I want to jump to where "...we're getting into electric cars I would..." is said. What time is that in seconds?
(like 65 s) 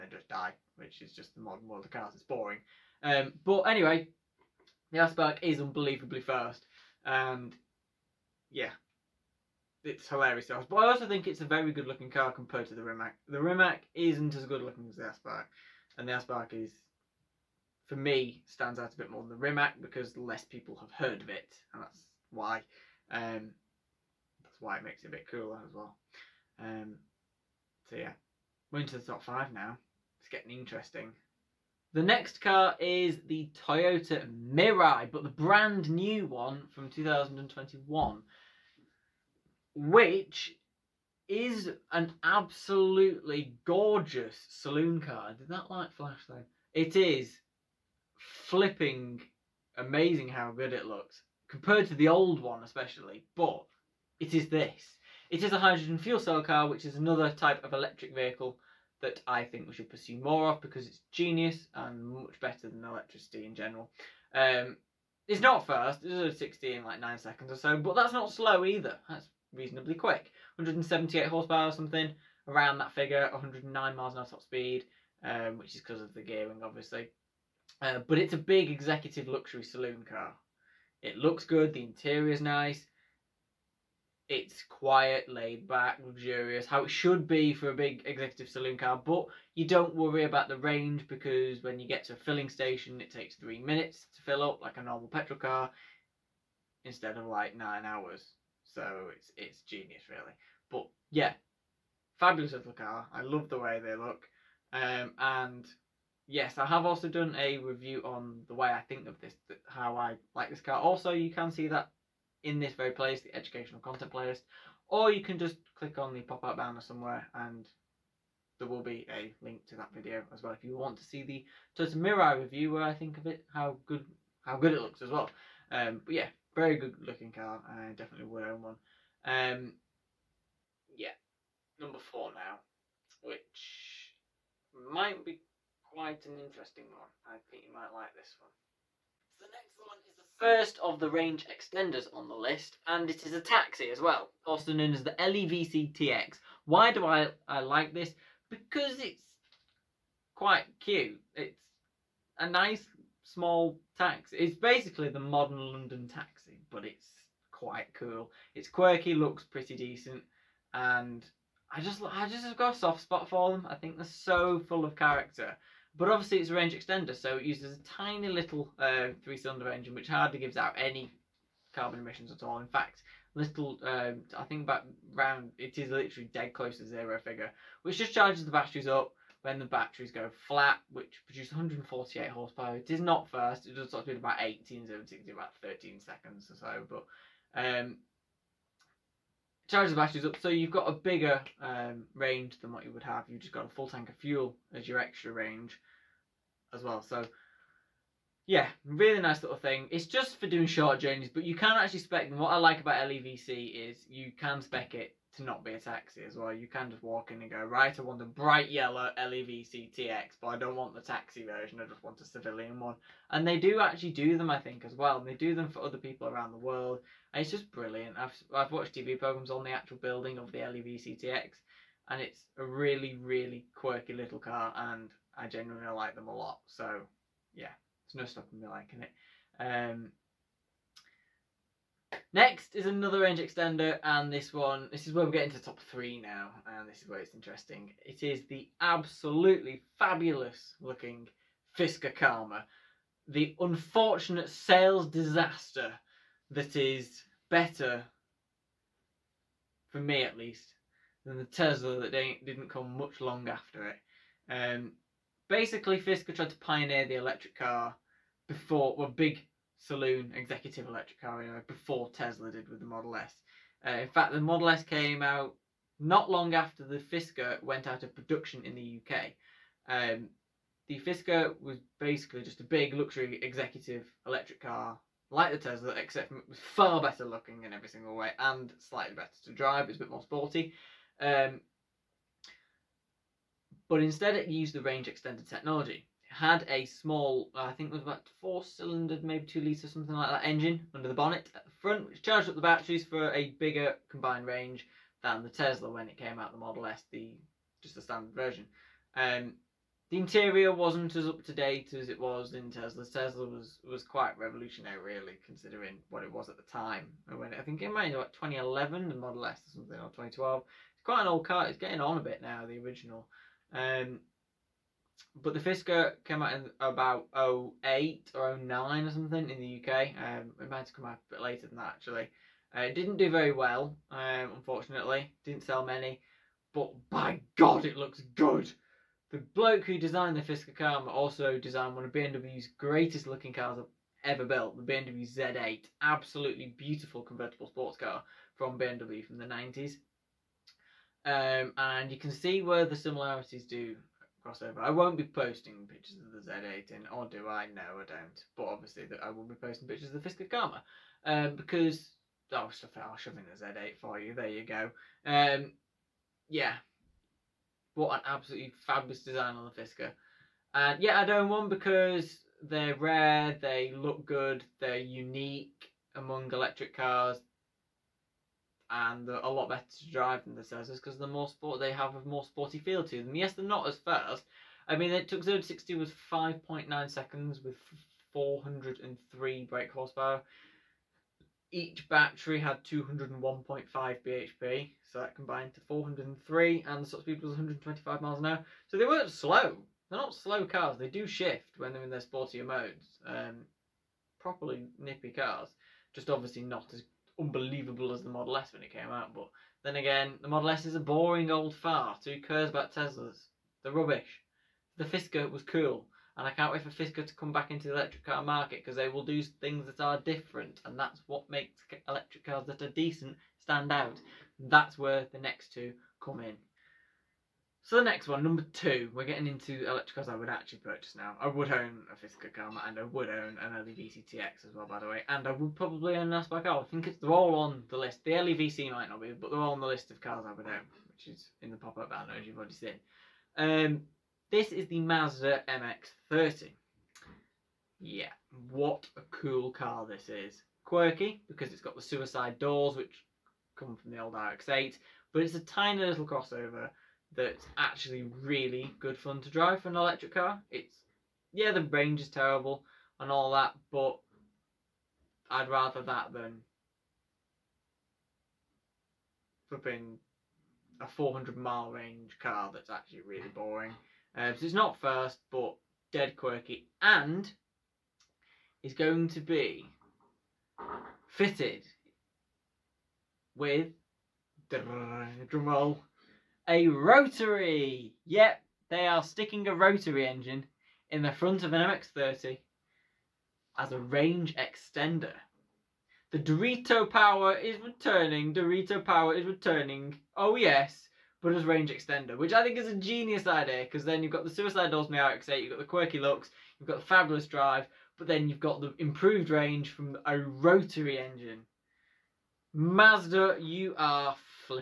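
419 s.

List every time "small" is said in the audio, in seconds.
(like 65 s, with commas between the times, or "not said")
153 s, 286 s.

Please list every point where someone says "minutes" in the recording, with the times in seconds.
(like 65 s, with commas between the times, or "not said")
93 s.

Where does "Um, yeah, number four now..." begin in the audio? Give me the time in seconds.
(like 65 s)
129 s.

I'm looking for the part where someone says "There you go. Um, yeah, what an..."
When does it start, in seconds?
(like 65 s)
354 s.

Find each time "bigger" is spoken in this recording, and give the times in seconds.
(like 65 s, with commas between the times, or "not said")
190 s, 293 s.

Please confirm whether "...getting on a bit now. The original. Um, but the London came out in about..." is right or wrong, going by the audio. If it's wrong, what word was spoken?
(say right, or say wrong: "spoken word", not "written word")
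wrong: "Fisker", not "London".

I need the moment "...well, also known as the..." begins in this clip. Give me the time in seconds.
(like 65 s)
143 s.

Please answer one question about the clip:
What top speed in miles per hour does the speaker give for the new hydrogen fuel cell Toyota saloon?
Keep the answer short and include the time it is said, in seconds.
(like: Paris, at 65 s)
109, at 73 s.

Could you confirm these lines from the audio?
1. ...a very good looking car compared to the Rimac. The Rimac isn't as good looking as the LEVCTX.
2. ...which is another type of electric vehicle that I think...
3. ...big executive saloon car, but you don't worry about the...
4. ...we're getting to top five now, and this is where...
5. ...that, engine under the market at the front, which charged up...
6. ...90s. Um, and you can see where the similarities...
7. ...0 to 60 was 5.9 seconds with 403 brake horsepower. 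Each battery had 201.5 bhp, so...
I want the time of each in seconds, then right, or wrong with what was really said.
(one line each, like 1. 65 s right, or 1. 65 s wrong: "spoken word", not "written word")
1. 11 s wrong: "Aspark", not "LEVCTX"
2. 56 s right
3. 87 s right
4. 235 s wrong: "three", not "five"
5. 290 s wrong: "bonnet", not "market"
6. 339 s right
7. 375 s right.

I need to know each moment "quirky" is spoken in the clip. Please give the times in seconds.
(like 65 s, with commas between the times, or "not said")
158 s, 223 s, 440 s, 466 s, 495 s.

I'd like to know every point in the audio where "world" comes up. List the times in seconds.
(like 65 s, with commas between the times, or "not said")
1 s, 216 s.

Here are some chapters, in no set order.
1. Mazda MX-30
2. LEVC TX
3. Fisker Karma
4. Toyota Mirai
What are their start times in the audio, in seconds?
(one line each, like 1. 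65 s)
1. 435 s
2. 144 s
3. 241 s
4. 33 s.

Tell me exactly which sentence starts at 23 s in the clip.
Um, that's why it makes it a bit cooler as well.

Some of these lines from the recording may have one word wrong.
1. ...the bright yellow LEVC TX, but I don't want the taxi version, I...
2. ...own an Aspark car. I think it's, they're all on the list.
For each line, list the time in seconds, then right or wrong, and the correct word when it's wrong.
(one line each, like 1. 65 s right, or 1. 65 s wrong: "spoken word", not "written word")
1. 208 s right
2. 426 s right.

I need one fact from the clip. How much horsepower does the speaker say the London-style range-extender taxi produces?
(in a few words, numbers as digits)
148.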